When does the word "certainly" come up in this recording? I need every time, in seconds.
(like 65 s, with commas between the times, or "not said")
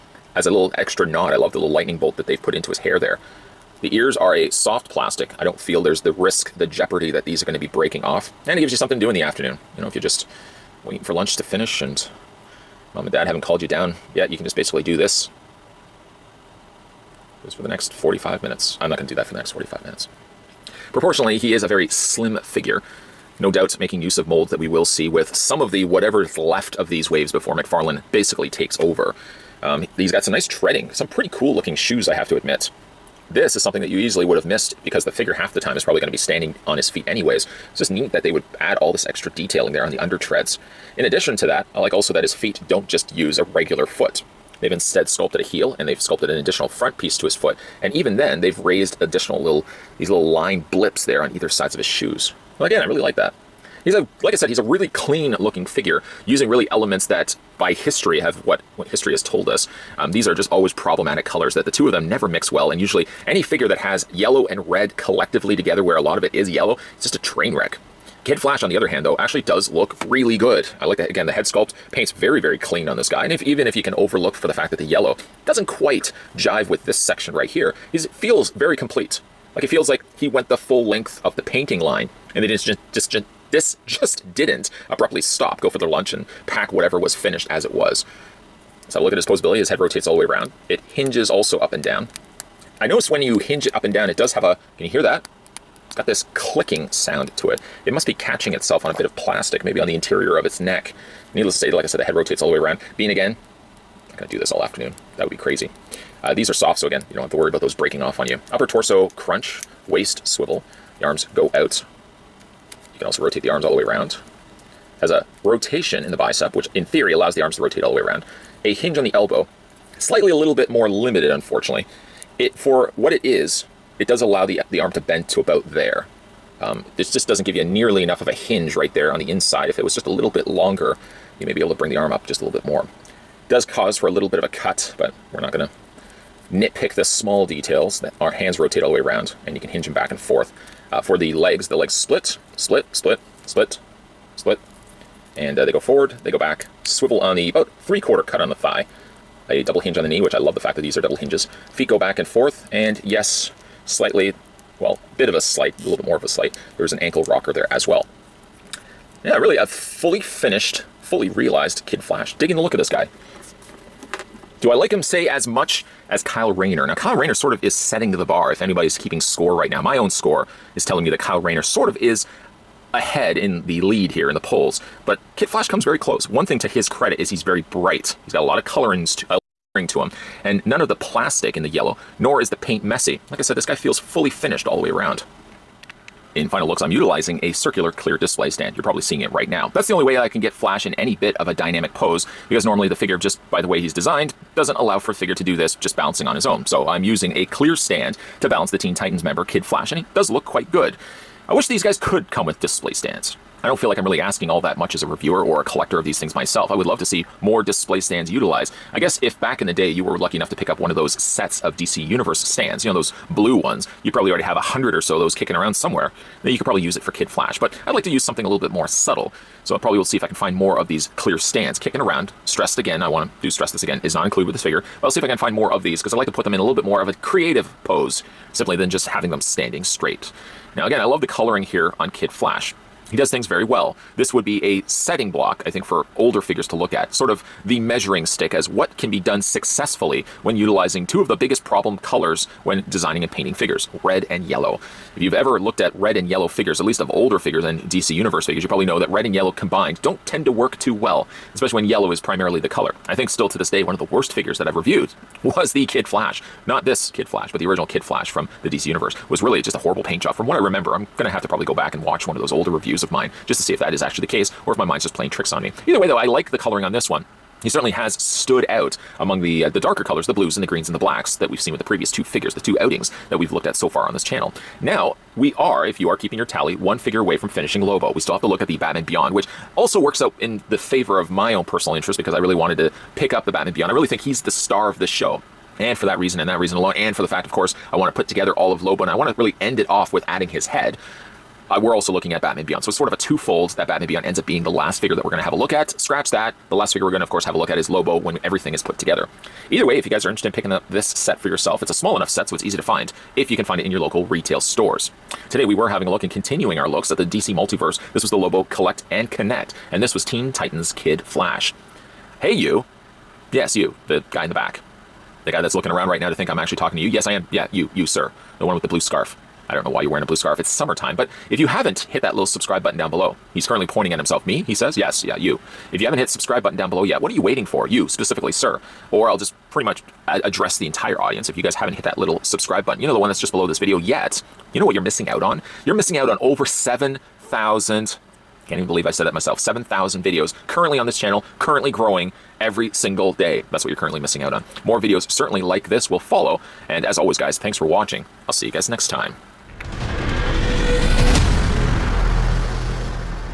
267 s, 345 s.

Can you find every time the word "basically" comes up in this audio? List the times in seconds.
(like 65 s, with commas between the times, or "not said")
14 s, 28 s.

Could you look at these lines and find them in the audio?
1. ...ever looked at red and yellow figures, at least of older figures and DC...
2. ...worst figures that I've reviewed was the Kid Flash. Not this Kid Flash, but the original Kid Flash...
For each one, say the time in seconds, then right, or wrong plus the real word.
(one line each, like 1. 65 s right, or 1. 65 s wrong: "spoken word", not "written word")
1. 245 s right
2. 254 s right.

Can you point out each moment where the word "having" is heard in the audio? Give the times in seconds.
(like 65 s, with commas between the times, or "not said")
229 s, 305 s.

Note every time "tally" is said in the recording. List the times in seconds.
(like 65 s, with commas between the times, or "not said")
276 s.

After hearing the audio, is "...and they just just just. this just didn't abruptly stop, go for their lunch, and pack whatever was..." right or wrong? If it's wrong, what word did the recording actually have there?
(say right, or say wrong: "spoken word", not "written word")
right.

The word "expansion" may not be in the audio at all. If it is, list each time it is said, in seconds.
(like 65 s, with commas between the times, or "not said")
not said.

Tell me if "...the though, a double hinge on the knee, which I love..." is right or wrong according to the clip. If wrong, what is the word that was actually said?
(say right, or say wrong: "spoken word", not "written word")
wrong: "thigh", not "though".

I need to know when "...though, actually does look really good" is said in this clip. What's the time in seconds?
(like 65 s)
69 s.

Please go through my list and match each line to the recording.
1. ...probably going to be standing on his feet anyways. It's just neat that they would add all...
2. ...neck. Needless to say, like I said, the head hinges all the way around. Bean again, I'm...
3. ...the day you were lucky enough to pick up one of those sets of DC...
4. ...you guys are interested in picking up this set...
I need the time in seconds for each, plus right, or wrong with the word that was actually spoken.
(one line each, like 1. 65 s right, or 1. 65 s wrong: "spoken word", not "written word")
1. 35 s right
2. 100 s wrong: "rotates", not "hinges"
3. 209 s right
4. 300 s right.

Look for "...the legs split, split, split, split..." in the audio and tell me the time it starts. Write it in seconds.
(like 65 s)
141 s.